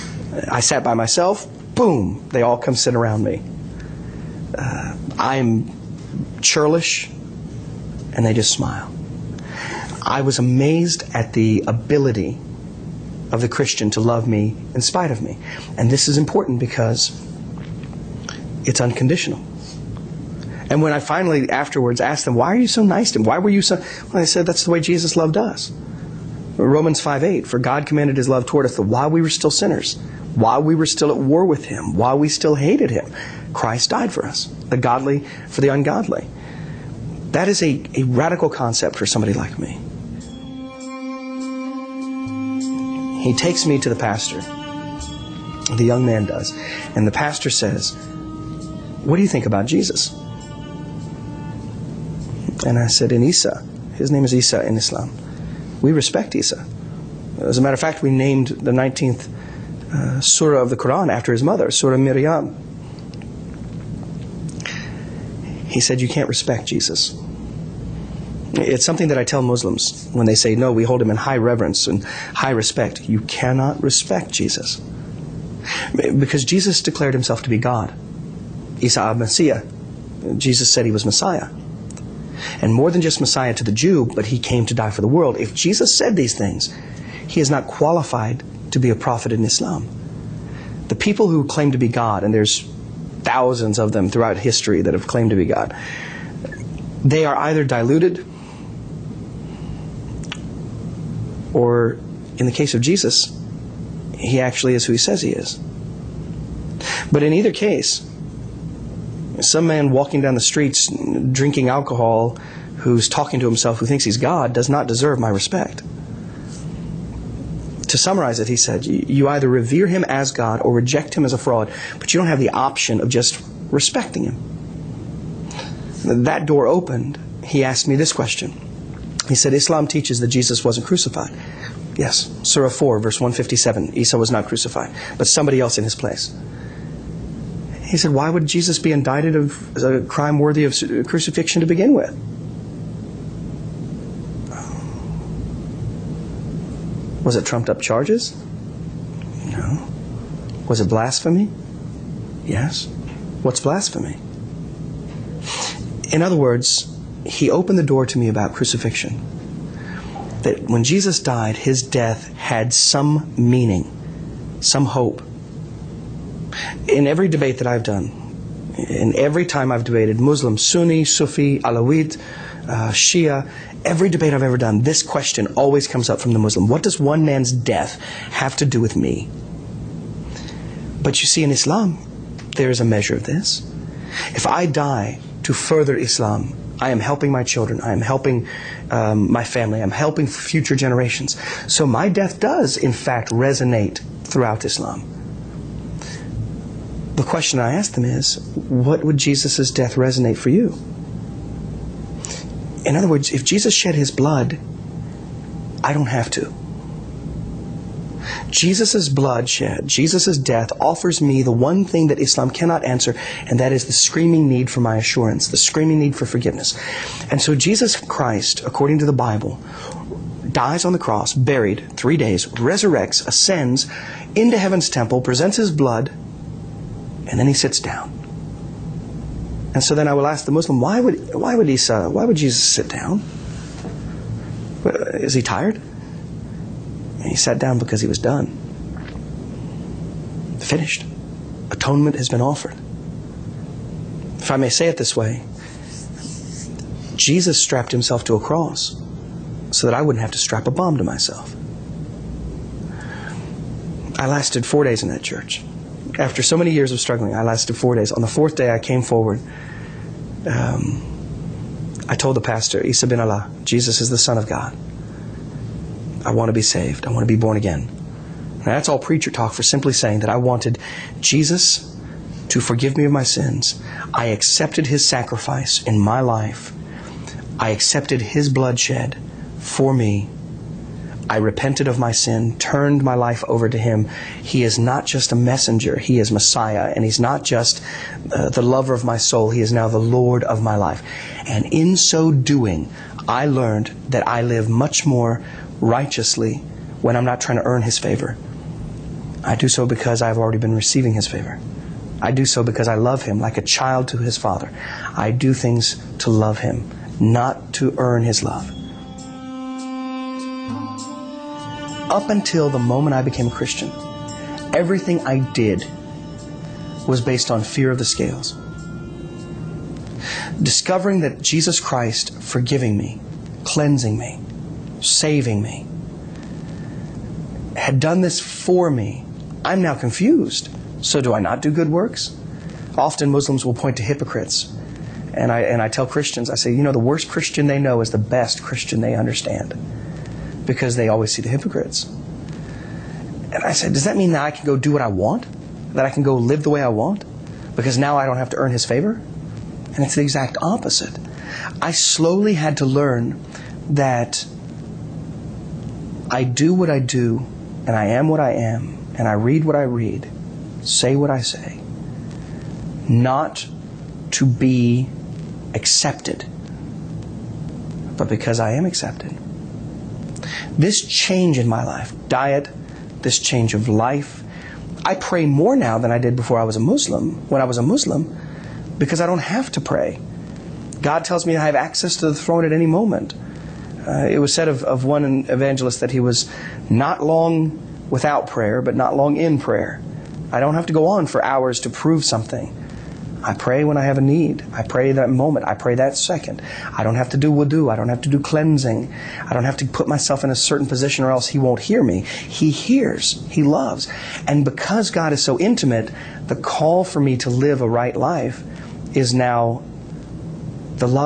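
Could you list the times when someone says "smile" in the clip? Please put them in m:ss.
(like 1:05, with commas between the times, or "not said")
0:08.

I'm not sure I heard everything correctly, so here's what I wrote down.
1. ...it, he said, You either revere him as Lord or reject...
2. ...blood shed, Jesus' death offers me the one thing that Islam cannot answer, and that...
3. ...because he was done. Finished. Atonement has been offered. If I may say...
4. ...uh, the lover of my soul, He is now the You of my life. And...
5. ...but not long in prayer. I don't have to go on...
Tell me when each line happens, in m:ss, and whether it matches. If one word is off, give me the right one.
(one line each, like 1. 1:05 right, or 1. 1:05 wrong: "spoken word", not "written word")
1. 1:58 wrong: "God", not "Lord"
2. 3:29 right
3. 3:57 right
4. 4:48 wrong: "Lord", not "You"
5. 6:28 right.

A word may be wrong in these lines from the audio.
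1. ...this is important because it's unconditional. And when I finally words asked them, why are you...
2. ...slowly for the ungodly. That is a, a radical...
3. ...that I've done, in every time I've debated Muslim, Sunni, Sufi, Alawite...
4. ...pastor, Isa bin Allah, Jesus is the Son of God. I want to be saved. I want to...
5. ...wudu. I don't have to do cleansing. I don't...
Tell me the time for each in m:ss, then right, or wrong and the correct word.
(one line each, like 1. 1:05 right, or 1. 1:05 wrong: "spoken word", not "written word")
1. 0:15 wrong: "afterwards", not "words"
2. 0:34 wrong: "godly", not "slowly"
3. 2:47 right
4. 4:22 right
5. 6:37 right.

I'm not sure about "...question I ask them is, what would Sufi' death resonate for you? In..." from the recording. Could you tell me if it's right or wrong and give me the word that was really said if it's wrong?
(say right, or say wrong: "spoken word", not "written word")
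wrong: "Jesus", not "Sufi".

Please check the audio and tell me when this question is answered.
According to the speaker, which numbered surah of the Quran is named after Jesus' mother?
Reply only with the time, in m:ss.
0:58.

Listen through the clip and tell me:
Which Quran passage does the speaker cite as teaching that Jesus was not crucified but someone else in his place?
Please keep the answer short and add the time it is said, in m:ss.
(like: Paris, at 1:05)
Surah 4, verse 157, at 2:12.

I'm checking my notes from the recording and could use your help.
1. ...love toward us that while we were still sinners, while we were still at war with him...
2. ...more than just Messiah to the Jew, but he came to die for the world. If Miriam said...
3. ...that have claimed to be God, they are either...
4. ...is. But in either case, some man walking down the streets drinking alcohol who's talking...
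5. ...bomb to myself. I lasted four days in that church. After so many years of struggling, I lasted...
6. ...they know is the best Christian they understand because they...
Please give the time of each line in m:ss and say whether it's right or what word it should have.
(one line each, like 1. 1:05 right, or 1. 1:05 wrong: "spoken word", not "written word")
1. 0:28 right
2. 1:22 wrong: "Jesus", not "Miriam"
3. 1:34 right
4. 1:45 right
5. 4:10 right
6. 5:37 right.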